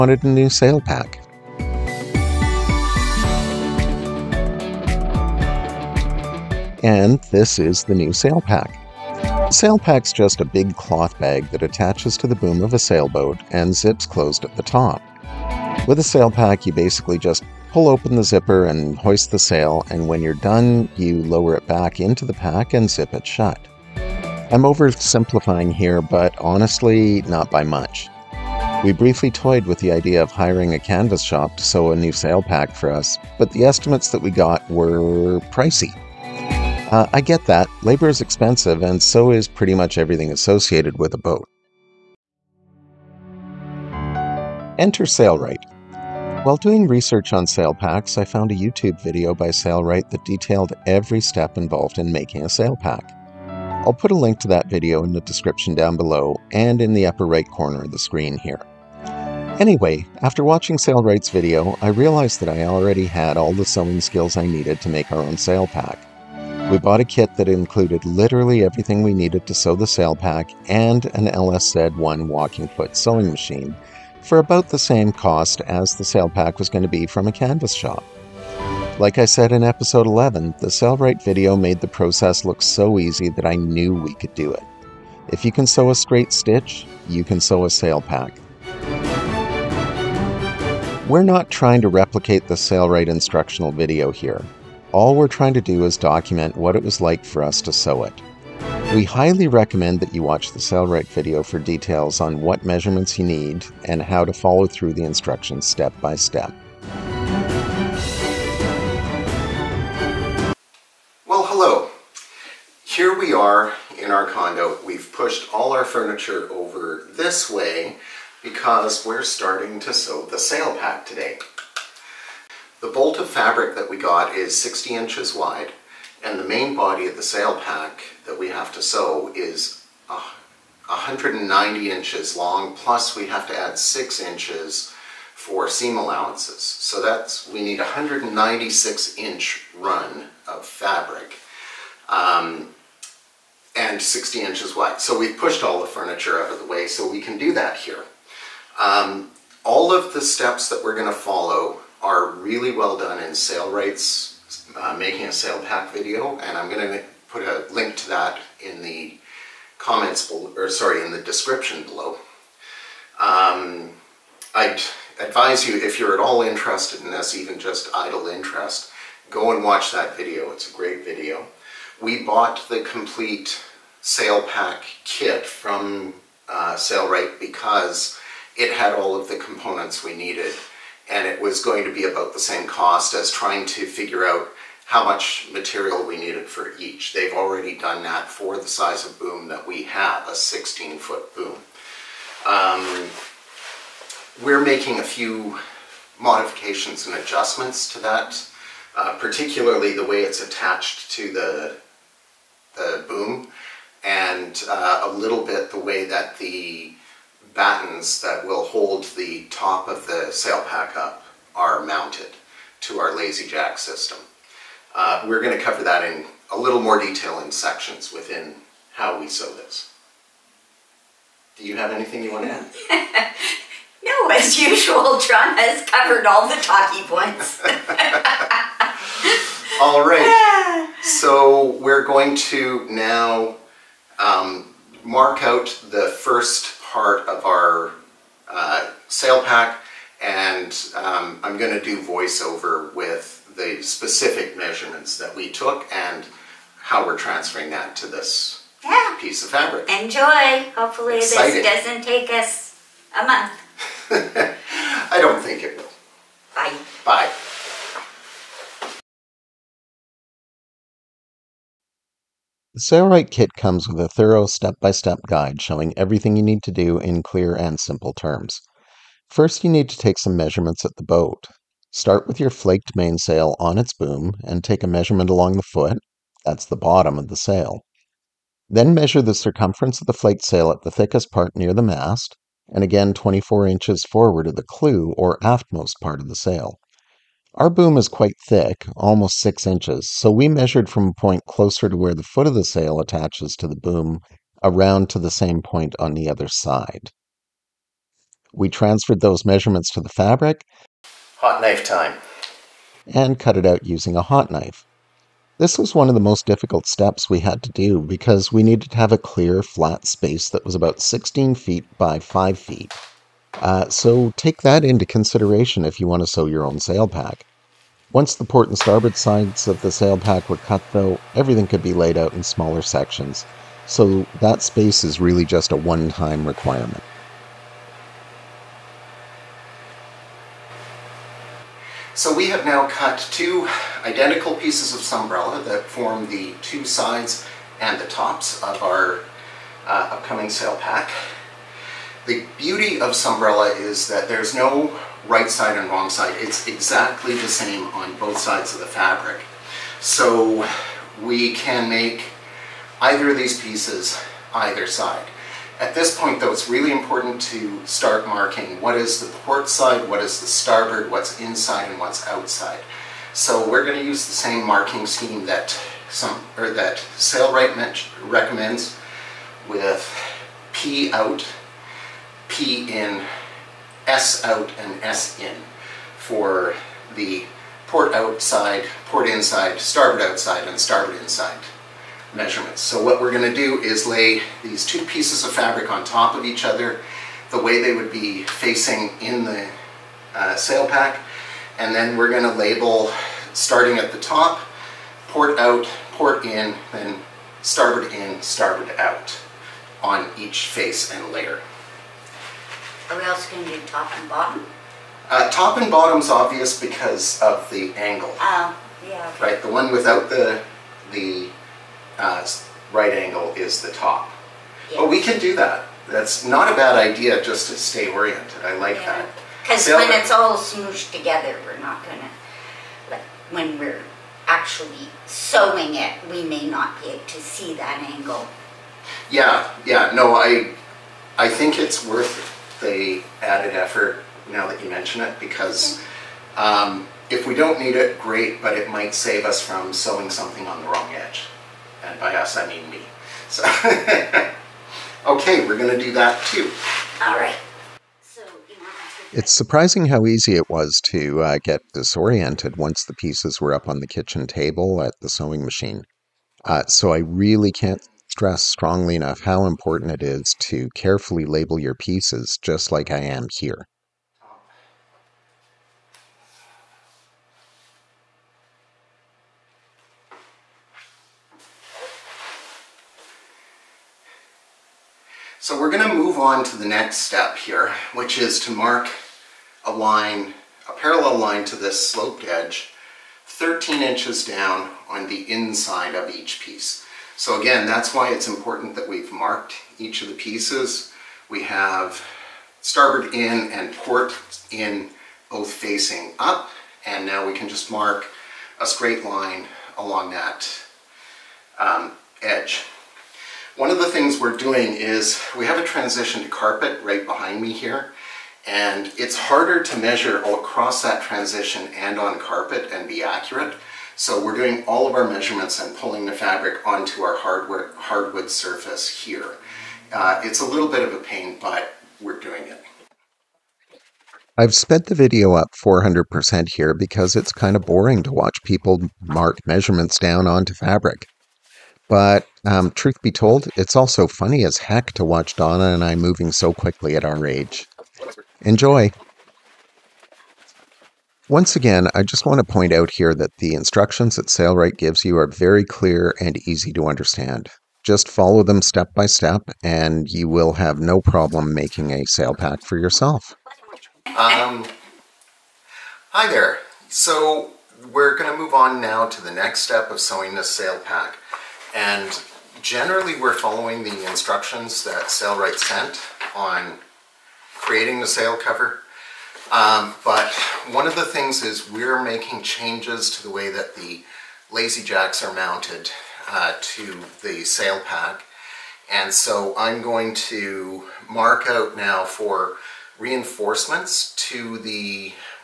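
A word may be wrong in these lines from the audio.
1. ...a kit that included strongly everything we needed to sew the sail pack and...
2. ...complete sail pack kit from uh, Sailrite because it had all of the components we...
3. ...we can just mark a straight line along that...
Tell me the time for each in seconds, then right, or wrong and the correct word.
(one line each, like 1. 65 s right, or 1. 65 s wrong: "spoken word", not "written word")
1. 66 s wrong: "literally", not "strongly"
2. 172 s right
3. 497 s right.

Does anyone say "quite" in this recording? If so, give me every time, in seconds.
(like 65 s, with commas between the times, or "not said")
288 s.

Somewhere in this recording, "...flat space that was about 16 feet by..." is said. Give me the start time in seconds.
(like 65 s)
309 s.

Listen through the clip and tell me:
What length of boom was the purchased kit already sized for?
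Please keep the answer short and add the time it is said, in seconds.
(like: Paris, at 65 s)
16 foot, at 190 s.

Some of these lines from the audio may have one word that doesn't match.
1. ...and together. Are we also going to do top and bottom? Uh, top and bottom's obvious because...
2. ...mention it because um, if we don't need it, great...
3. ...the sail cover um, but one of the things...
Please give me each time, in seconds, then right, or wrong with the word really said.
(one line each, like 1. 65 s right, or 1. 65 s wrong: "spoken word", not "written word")
1. 401 s wrong: "layer", not "together"
2. 434 s right
3. 568 s right.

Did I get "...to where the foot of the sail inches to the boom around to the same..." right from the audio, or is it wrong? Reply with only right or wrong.
wrong.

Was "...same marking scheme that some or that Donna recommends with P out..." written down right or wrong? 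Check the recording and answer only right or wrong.
wrong.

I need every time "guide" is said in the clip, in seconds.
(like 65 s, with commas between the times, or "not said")
265 s.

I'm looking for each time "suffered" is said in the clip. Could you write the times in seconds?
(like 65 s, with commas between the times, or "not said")
not said.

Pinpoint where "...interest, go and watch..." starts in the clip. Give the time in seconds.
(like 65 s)
168 s.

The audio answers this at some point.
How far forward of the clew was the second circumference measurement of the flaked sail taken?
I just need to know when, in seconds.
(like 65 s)
283 s.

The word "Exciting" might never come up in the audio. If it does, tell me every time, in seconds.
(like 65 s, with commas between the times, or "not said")
251 s.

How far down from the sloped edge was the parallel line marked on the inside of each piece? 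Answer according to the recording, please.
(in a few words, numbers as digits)
13 inches.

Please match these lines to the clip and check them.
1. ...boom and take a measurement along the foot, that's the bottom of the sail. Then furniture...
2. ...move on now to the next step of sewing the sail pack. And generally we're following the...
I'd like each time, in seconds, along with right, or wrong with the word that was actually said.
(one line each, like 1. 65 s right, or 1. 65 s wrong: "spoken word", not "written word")
1. 273 s wrong: "measure", not "furniture"
2. 558 s right.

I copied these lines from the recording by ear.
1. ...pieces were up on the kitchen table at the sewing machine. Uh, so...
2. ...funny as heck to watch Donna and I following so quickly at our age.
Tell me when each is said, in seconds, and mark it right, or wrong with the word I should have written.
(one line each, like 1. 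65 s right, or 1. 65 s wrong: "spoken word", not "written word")
1. 453 s right
2. 534 s wrong: "moving", not "following".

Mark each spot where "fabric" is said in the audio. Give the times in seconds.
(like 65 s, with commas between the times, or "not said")
123 s, 140 s, 249 s, 300 s, 348 s, 385 s, 516 s, 530 s.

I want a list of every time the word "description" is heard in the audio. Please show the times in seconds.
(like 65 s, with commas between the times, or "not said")
55 s, 161 s.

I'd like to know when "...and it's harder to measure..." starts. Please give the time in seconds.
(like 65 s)
508 s.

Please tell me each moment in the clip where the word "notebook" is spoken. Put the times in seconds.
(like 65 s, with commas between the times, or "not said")
not said.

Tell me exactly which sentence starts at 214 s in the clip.
Uh, we're going to cover that in a little more detail in sections within how we sew this.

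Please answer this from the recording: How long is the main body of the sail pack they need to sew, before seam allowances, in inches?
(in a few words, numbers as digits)
190 inches.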